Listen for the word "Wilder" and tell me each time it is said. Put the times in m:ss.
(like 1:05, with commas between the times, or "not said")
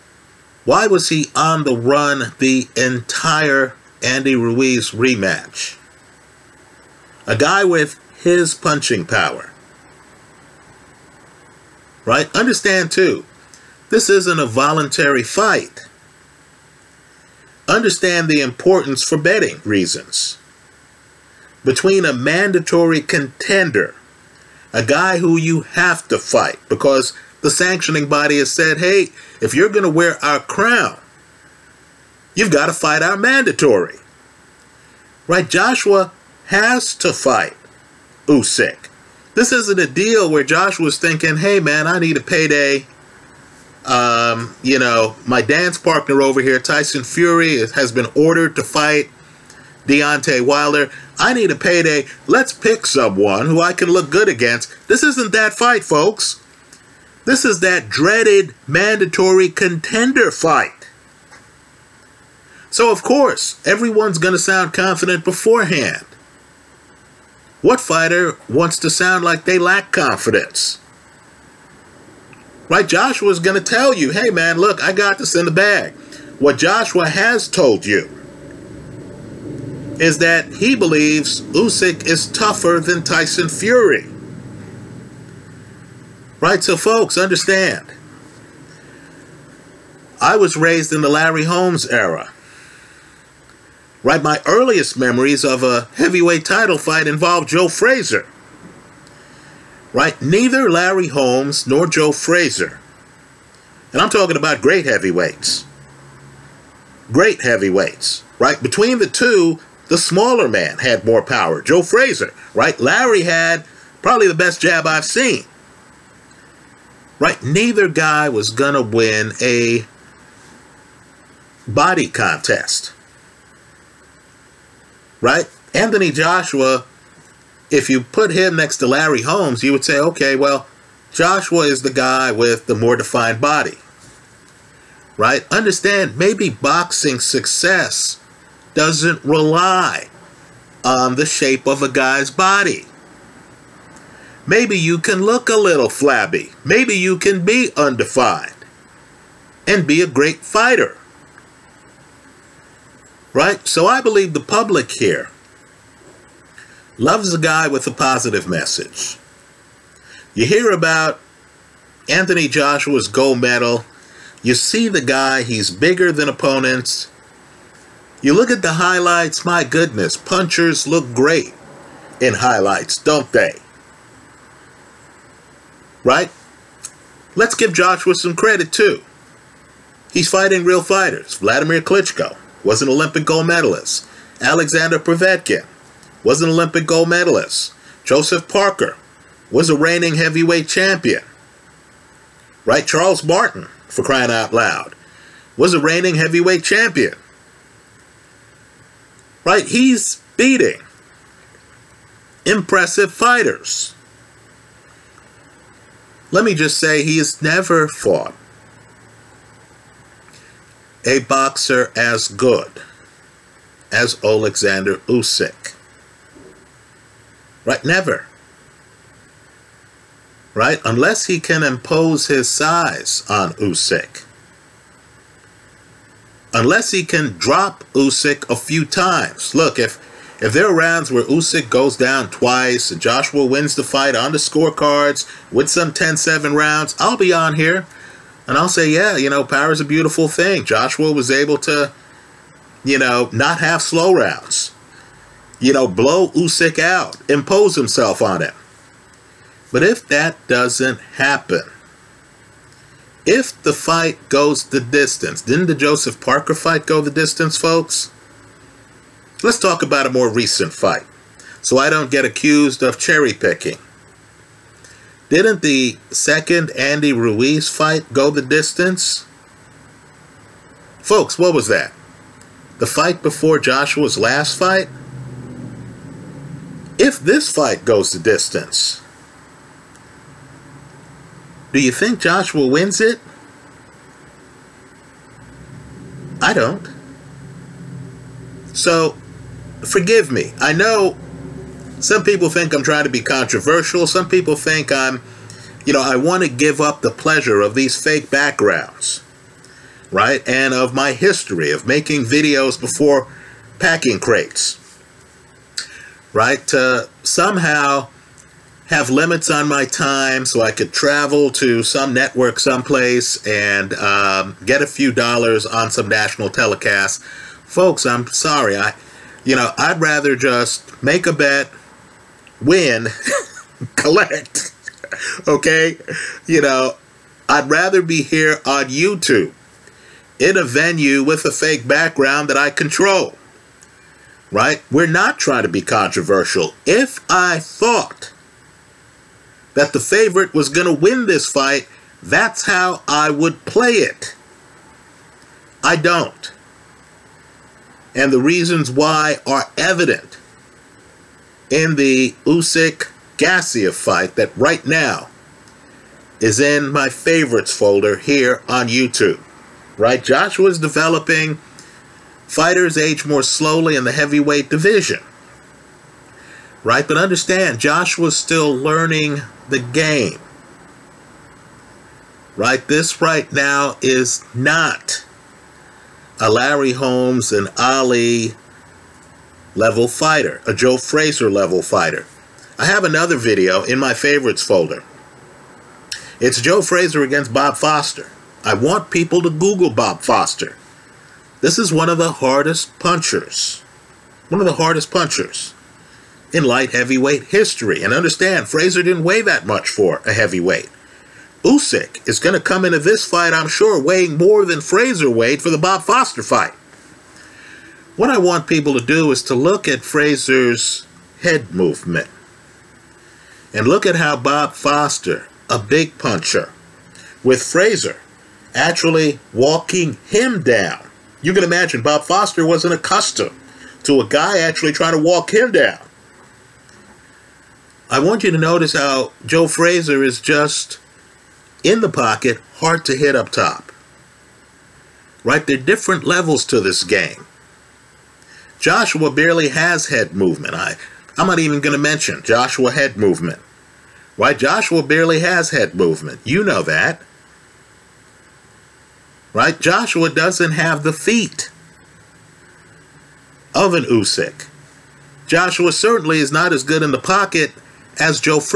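0:50.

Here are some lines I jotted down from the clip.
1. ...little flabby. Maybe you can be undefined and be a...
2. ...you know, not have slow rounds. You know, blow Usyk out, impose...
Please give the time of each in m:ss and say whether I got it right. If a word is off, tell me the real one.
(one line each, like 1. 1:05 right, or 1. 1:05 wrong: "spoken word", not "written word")
1. 2:25 right
2. 4:02 right.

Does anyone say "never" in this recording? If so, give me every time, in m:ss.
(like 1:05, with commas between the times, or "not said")
3:27, 3:37.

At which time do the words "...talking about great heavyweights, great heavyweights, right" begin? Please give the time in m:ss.
1:44.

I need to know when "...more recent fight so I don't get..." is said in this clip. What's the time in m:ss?
4:20.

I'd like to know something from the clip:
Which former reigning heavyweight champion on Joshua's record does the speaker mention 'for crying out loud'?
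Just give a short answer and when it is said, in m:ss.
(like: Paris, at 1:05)
Charles Martin, at 3:12.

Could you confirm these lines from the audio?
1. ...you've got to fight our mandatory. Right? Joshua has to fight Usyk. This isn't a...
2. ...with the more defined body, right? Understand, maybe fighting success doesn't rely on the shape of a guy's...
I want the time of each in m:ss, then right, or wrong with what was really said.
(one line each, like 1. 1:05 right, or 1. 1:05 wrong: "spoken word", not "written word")
1. 0:32 right
2. 2:12 wrong: "boxing", not "fighting".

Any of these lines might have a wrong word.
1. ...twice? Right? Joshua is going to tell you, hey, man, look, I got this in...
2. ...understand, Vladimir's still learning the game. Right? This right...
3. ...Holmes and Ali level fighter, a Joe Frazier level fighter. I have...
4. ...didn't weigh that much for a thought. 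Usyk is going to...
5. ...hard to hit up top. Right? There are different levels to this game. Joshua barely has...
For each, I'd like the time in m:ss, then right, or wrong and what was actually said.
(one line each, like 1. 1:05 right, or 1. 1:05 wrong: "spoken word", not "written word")
1. 1:09 wrong: "confidence", not "twice"
2. 6:07 wrong: "Joshua", not "Vladimir"
3. 6:16 right
4. 6:39 wrong: "heavyweight", not "thought"
5. 7:12 right.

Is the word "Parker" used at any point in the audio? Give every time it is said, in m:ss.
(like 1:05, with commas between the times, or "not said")
3:08, 4:16.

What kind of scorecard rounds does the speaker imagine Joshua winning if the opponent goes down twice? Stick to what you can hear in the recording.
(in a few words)
10-7 rounds.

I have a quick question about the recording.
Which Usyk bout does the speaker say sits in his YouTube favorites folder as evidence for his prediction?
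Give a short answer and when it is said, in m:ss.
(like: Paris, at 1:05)
Usyk Gassiev, at 5:52.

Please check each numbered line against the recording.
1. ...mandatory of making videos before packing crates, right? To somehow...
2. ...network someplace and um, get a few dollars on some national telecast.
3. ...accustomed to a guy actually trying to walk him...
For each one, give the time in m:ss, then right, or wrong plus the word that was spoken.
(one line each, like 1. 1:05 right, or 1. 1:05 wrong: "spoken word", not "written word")
1. 5:01 wrong: "history", not "mandatory"
2. 5:12 right
3. 7:02 right.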